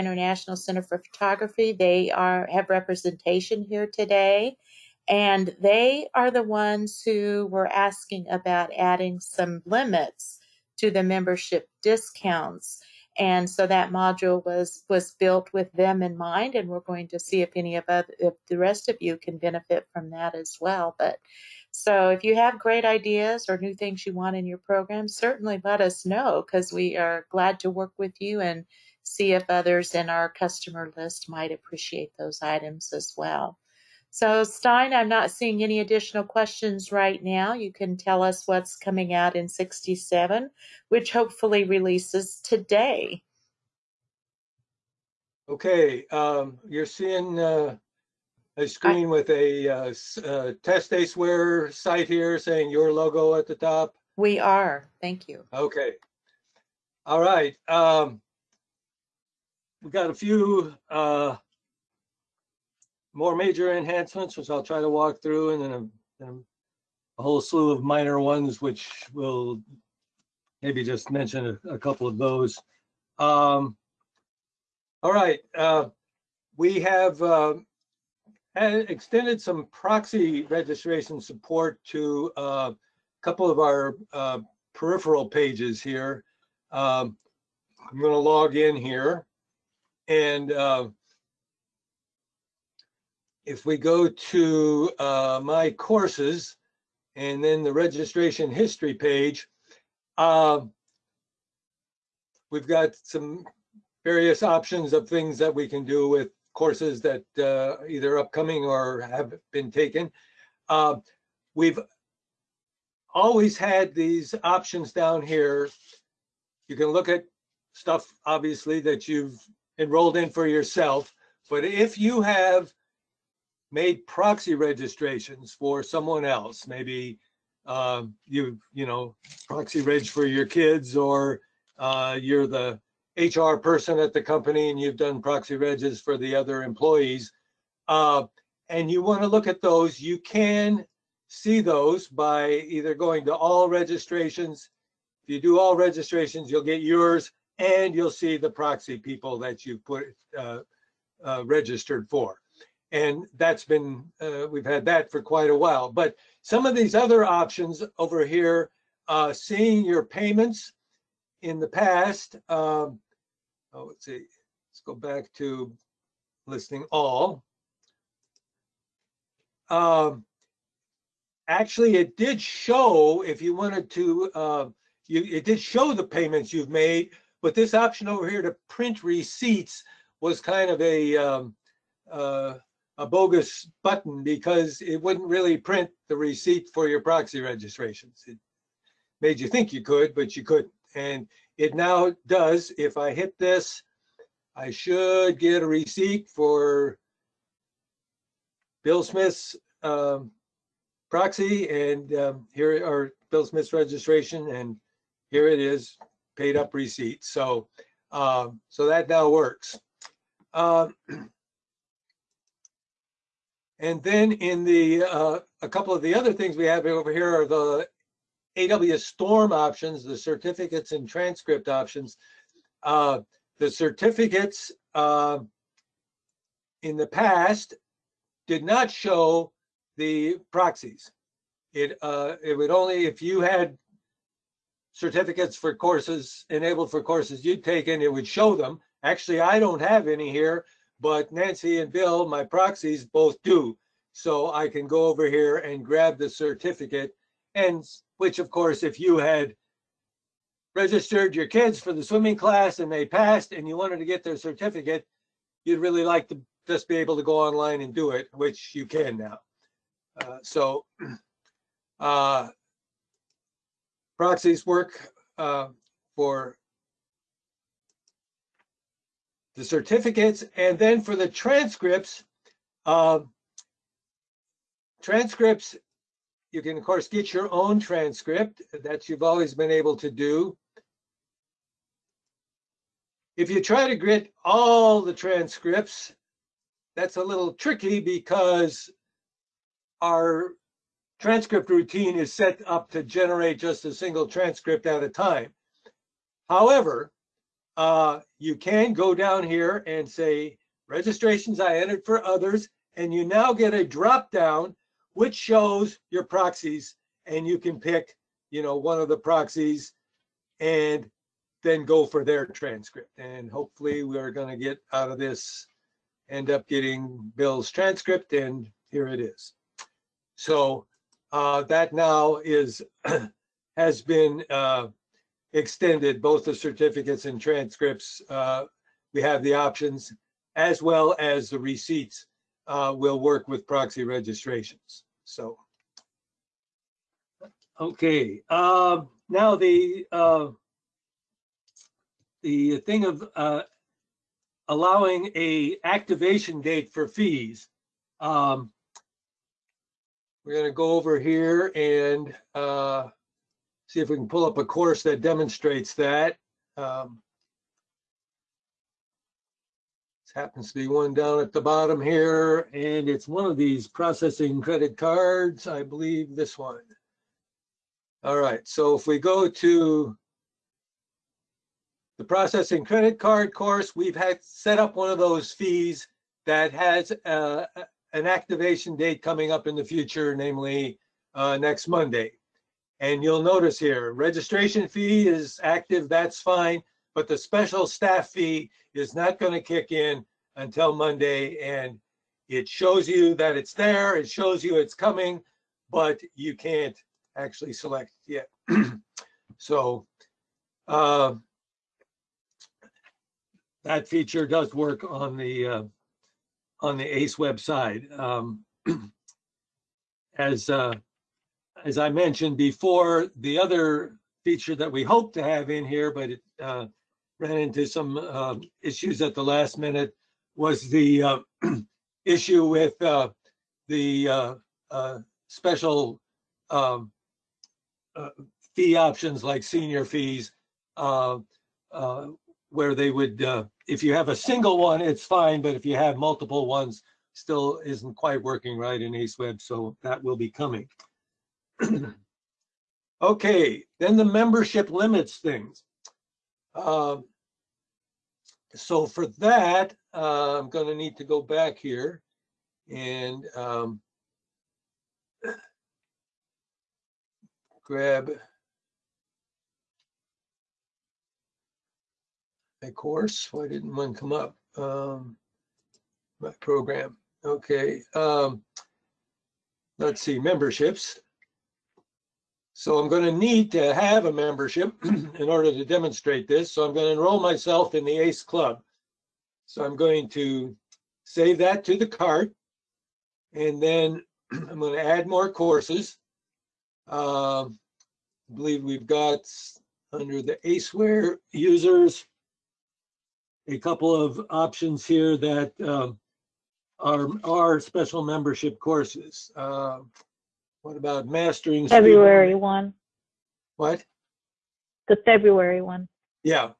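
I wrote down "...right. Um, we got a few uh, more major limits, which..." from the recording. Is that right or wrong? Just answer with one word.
wrong.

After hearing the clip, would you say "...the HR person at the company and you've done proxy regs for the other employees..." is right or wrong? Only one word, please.
right.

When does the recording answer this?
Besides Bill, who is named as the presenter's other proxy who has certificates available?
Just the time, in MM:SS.
04:01.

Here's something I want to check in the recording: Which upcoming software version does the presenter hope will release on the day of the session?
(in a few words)
67.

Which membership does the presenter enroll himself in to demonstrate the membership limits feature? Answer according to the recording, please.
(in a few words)
ACE Club.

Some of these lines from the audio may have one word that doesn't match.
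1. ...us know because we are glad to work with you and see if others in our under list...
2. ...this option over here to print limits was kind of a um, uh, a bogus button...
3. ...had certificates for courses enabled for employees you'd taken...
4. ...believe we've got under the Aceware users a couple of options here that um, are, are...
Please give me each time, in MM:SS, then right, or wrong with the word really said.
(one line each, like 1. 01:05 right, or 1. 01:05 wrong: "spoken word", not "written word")
1. 00:25 wrong: "customer", not "under"
2. 02:57 wrong: "receipts", not "limits"
3. 03:53 wrong: "courses", not "employees"
4. 08:08 right.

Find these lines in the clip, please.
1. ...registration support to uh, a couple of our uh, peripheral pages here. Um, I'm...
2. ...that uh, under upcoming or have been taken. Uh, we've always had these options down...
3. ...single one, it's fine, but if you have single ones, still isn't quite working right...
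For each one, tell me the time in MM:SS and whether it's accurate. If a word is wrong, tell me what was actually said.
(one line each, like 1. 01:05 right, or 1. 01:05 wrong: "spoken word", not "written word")
1. 01:20 right
2. 01:47 wrong: "either", not "under"
3. 07:14 wrong: "multiple", not "single".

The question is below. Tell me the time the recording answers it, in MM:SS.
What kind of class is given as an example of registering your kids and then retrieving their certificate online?
04:12.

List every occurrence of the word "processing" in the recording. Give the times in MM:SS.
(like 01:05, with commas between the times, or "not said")
06:03, 06:12.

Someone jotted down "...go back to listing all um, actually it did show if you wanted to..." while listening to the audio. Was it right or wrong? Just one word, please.
right.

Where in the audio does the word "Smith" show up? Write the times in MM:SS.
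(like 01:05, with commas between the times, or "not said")
03:19, 03:23.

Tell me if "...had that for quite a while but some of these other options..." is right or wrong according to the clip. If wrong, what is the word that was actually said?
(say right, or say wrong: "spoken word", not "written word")
right.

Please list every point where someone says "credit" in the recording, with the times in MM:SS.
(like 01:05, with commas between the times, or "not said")
06:04, 06:12.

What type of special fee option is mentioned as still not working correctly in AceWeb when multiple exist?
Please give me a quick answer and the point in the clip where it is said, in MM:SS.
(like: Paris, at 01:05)
senior fees, at 07:09.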